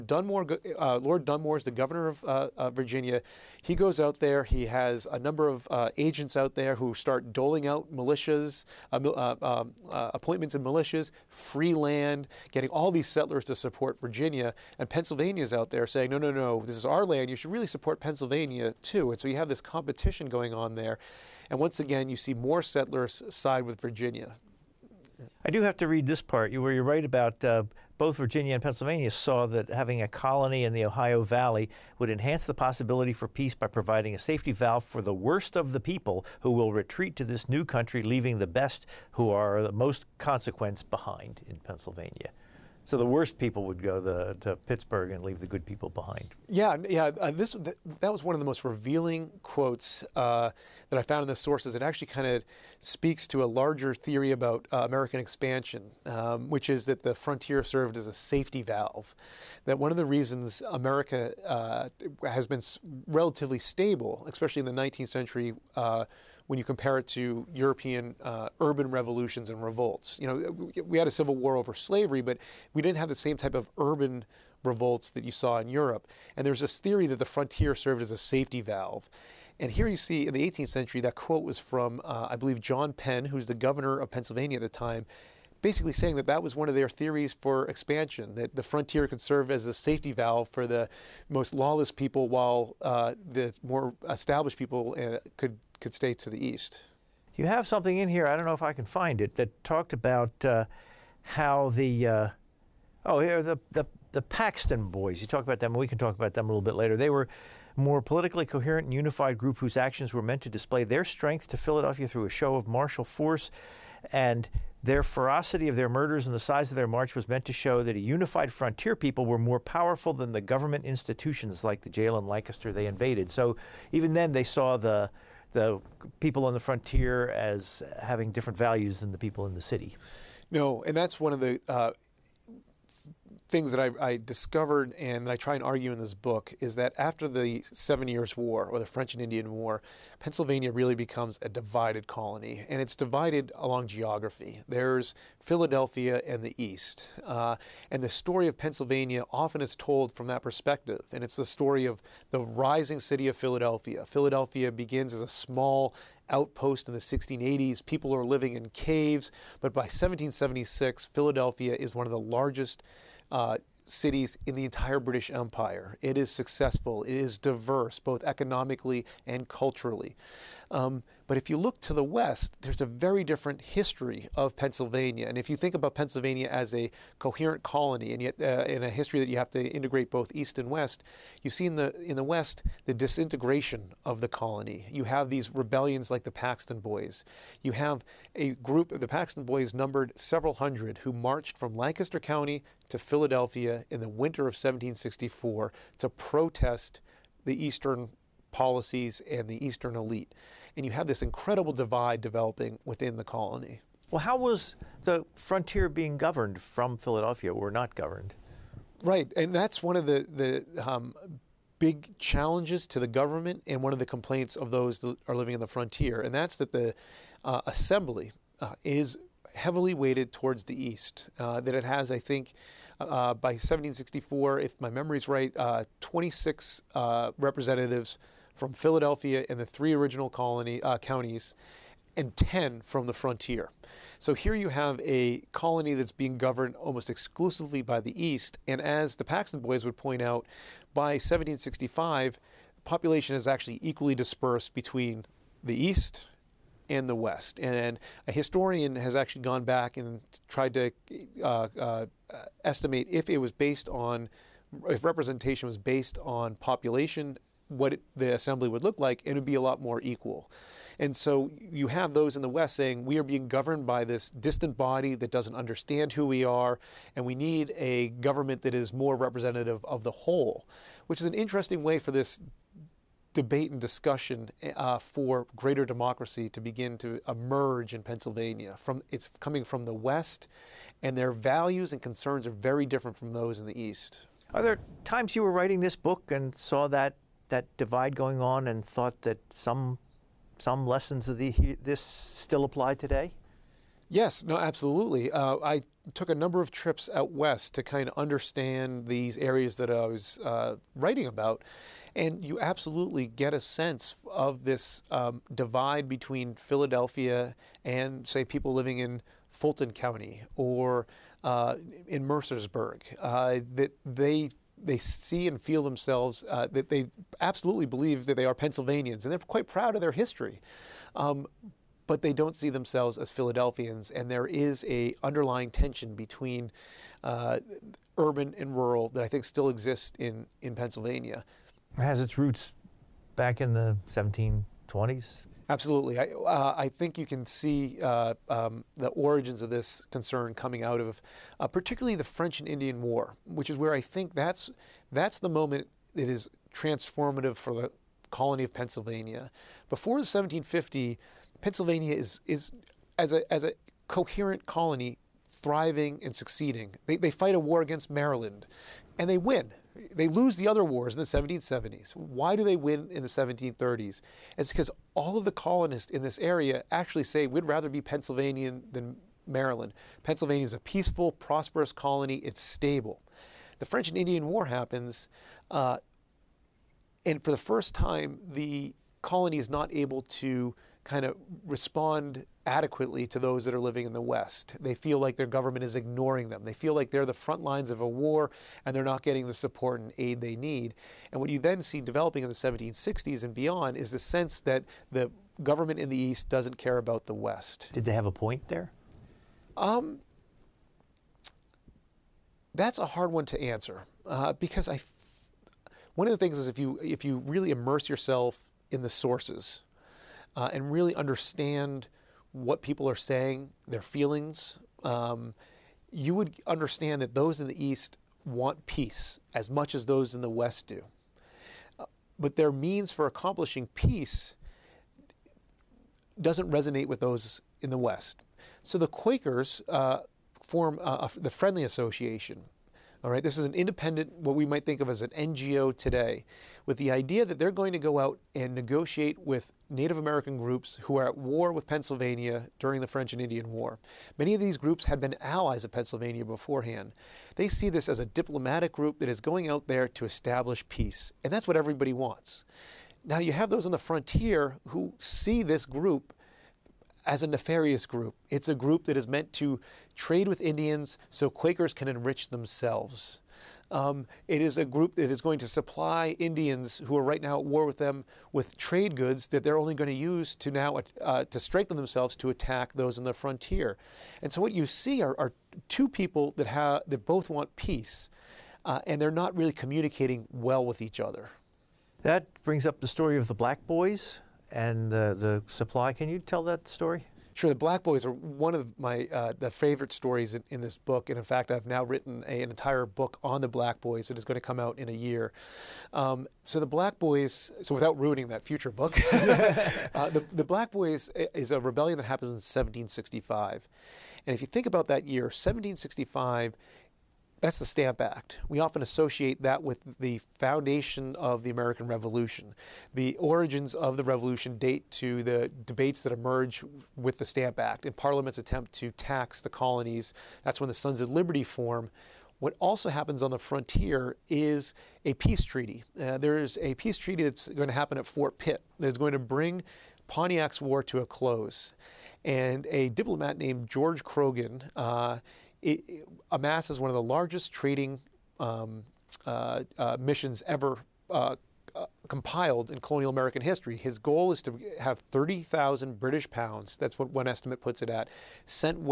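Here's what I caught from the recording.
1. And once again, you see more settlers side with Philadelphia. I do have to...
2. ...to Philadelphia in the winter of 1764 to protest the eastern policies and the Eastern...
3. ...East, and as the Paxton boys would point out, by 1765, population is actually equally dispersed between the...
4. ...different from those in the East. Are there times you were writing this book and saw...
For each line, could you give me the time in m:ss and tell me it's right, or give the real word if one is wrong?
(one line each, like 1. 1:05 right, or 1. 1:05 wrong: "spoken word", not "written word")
1. 0:21 wrong: "Virginia", not "Philadelphia"
2. 3:12 right
3. 3:58 right
4. 4:42 right.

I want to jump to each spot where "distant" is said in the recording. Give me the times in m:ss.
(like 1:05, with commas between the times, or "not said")
4:24.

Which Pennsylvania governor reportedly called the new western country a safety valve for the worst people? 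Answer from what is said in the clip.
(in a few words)
John Penn.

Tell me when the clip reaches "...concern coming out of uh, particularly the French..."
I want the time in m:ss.
5:40.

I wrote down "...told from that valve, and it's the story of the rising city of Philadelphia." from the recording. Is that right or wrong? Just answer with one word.
wrong.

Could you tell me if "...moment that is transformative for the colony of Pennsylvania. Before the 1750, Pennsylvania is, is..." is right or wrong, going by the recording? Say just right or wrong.
right.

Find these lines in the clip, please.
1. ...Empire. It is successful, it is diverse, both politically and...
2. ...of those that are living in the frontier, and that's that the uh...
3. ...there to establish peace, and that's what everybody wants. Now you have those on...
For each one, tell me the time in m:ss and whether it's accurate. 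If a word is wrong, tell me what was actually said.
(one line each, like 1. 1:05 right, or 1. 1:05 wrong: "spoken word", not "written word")
1. 2:45 wrong: "economically", not "politically"
2. 3:34 right
3. 7:29 right.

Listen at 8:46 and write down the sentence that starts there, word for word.
Uh, there's a peace treaty that's going to happen at Fort Pitt that is going to bring Pontiac's War to a close.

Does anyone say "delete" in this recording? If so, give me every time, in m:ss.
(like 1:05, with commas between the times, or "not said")
not said.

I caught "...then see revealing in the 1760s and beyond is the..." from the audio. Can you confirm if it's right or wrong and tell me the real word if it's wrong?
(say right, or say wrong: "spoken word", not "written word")
wrong: "developing", not "revealing".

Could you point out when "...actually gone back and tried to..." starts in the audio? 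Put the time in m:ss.
4:09.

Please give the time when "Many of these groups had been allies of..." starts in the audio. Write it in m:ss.
7:24.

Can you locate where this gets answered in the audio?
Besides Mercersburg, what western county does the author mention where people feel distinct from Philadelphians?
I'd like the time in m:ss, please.
5:09.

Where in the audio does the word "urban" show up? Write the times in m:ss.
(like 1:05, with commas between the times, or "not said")
1:08, 1:13, 5:28.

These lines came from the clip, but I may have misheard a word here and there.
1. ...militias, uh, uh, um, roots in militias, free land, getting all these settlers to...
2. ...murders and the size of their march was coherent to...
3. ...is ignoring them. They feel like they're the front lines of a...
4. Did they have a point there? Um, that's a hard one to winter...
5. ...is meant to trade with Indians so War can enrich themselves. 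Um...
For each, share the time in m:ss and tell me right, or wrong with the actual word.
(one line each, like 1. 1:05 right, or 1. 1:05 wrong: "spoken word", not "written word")
1. 0:07 wrong: "appointments", not "roots"
2. 1:55 wrong: "meant", not "coherent"
3. 6:25 right
4. 6:37 wrong: "answer", not "winter"
5. 7:39 wrong: "Quakers", not "War".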